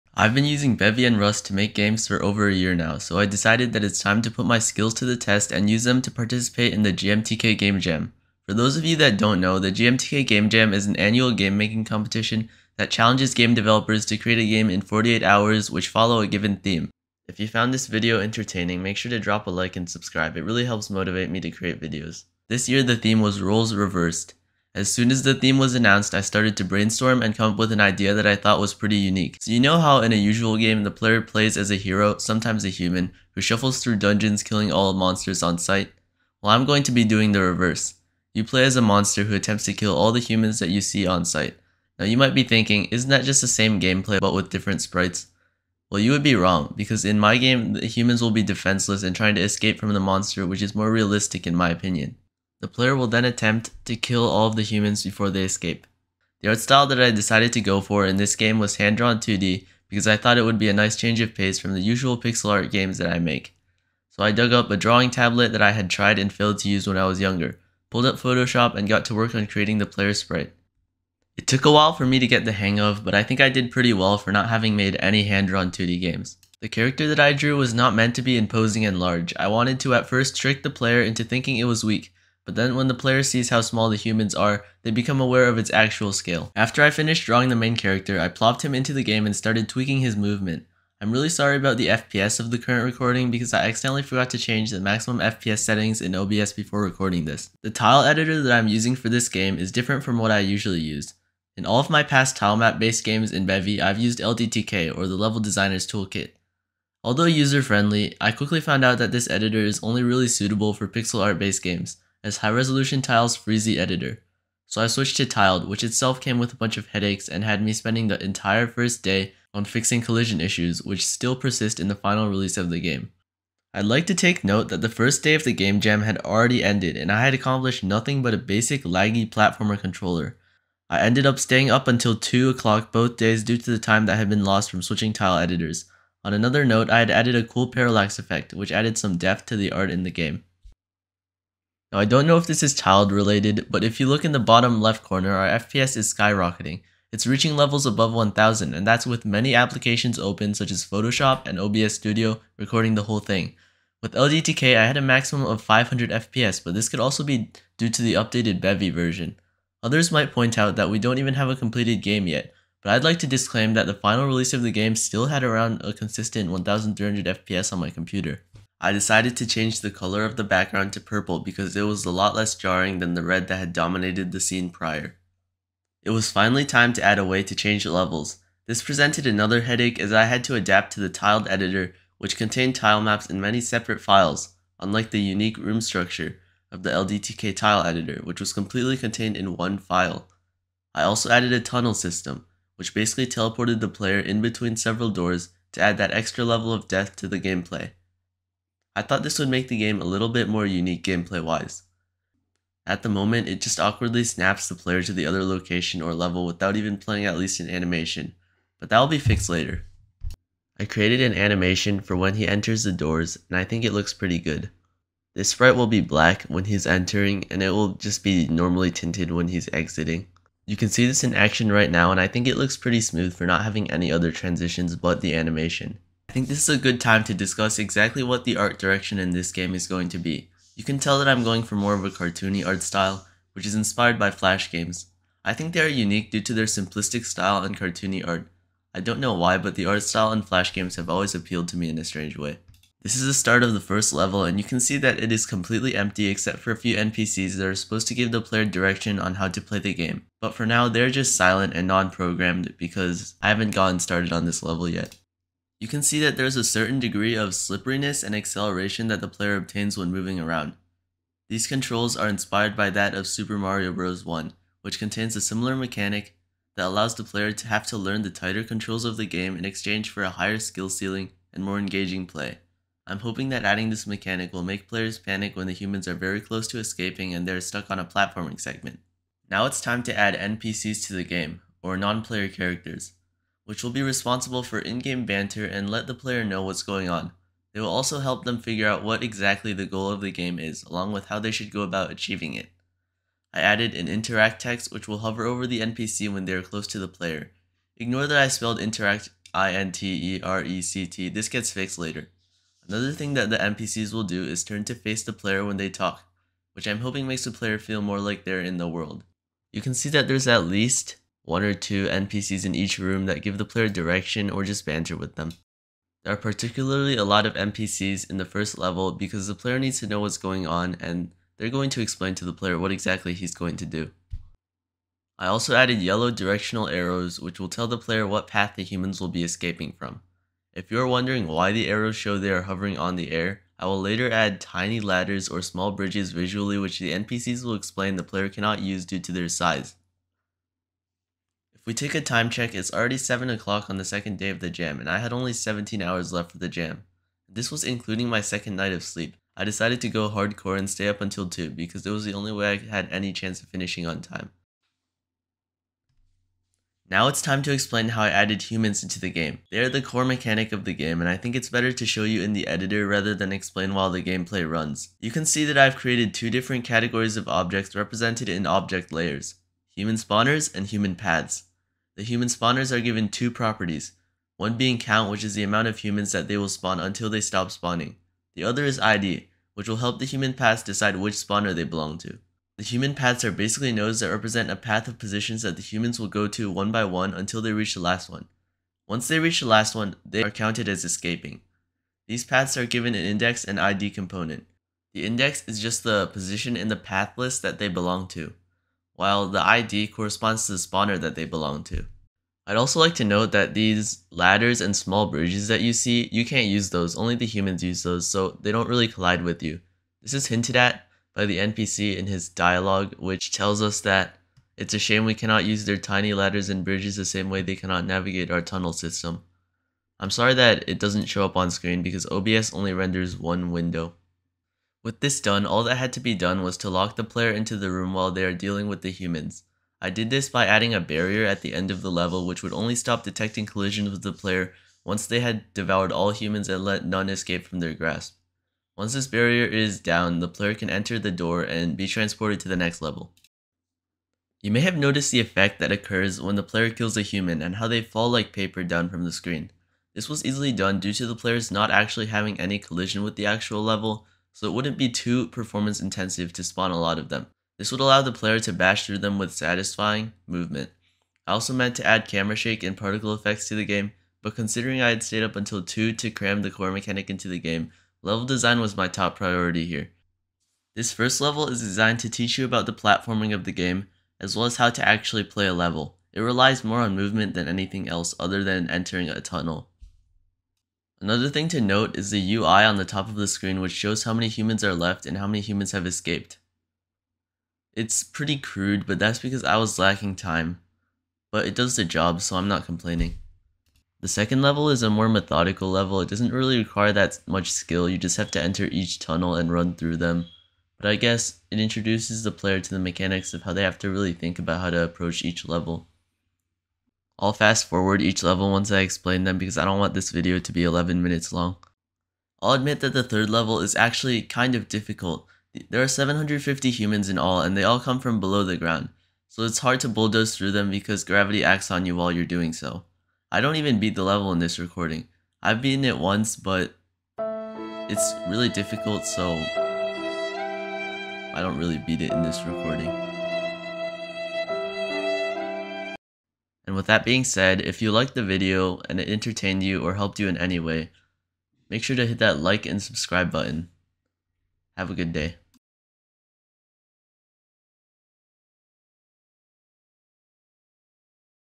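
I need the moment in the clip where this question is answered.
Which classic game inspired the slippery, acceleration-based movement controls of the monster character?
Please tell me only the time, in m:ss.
4:23.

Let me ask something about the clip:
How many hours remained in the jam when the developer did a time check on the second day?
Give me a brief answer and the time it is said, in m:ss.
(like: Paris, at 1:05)
17, at 5:45.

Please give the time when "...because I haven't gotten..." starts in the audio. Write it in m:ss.
4:12.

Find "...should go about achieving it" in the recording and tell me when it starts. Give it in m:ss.
4:51.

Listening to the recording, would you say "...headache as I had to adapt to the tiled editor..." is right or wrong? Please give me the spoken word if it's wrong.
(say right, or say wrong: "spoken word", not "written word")
right.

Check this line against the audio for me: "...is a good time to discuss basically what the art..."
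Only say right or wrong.
wrong.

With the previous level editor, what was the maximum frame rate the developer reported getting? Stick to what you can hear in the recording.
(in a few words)
500 FPS.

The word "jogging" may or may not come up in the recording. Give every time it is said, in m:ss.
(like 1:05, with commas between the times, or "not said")
not said.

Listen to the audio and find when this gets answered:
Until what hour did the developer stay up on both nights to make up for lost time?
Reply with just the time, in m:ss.
2:12.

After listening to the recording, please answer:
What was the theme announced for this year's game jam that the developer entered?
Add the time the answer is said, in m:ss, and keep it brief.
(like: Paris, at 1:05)
Roles reversed, at 0:23.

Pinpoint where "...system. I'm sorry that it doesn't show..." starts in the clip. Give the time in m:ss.
6:58.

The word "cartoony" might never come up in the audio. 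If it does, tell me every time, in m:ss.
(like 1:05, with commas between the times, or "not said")
3:52, 3:57.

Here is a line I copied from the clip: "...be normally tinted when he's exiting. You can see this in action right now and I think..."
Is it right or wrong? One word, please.
right.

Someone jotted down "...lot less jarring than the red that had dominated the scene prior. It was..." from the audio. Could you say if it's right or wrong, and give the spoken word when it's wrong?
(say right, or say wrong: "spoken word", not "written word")
right.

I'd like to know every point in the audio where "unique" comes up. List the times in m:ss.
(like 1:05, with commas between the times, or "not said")
0:28, 3:05, 3:20, 3:55.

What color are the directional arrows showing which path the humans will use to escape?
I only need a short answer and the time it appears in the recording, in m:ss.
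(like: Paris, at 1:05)
Yellow, at 5:25.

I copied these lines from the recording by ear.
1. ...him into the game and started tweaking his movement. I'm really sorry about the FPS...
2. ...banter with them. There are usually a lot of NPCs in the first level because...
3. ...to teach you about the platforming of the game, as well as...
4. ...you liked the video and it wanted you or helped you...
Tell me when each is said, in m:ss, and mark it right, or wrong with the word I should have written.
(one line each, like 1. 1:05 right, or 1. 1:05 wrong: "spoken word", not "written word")
1. 1:28 right
2. 5:14 wrong: "particularly", not "usually"
3. 7:52 right
4. 8:57 wrong: "entertained", not "wanted".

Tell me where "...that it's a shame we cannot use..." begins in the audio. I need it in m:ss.
6:54.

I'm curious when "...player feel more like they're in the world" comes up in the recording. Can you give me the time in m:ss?
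5:07.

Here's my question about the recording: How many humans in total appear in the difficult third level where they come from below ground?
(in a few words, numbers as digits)
750.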